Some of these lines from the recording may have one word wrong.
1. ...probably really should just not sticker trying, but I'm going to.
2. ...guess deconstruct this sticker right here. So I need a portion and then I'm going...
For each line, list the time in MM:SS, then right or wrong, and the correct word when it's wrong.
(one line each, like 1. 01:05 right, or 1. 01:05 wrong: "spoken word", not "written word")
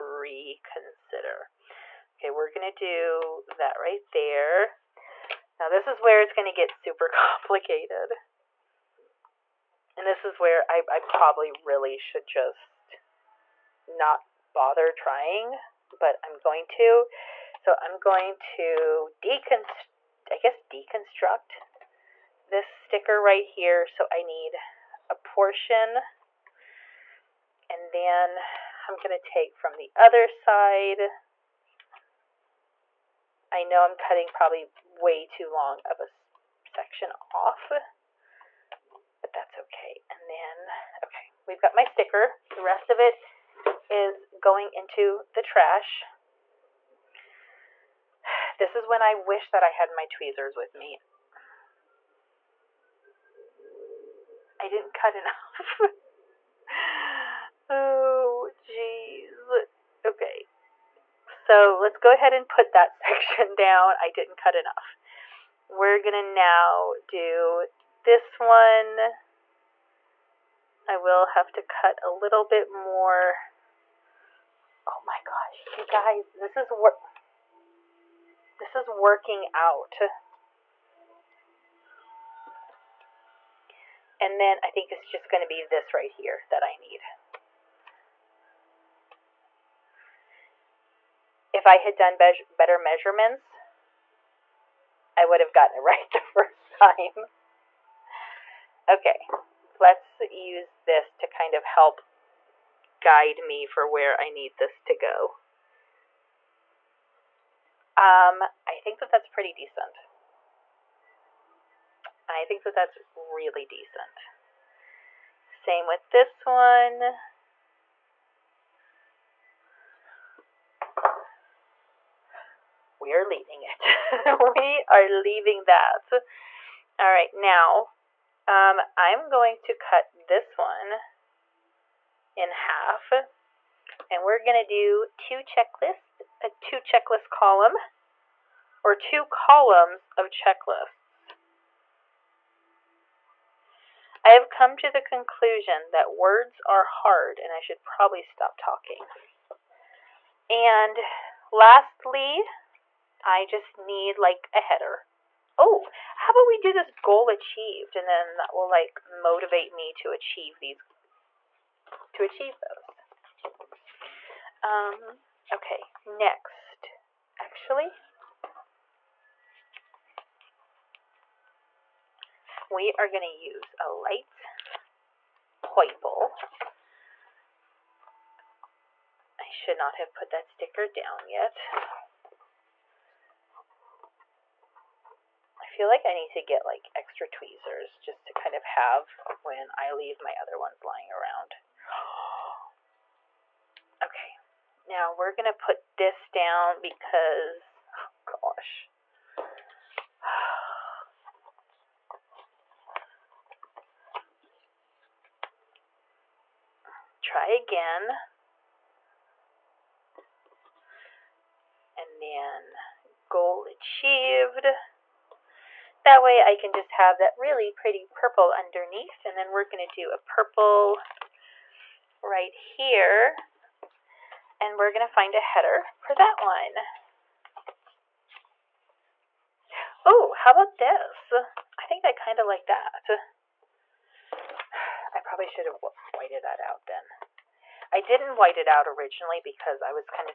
1. 00:10 wrong: "bother", not "sticker"
2. 00:20 right.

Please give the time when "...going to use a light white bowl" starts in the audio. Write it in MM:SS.
02:53.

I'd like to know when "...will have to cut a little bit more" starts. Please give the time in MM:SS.
01:10.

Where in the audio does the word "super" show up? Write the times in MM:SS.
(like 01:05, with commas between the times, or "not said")
00:06.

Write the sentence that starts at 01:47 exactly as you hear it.
Um, I think that that's pretty decent.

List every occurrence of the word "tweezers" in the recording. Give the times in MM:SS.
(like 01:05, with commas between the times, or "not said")
00:50, 03:07.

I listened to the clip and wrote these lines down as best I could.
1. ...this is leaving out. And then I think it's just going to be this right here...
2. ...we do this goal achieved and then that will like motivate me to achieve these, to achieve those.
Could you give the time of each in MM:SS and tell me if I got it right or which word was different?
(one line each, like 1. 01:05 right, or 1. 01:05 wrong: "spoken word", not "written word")
1. 01:18 wrong: "working", not "leaving"
2. 02:36 right.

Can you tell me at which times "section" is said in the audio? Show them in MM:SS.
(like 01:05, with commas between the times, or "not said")
00:36, 01:02.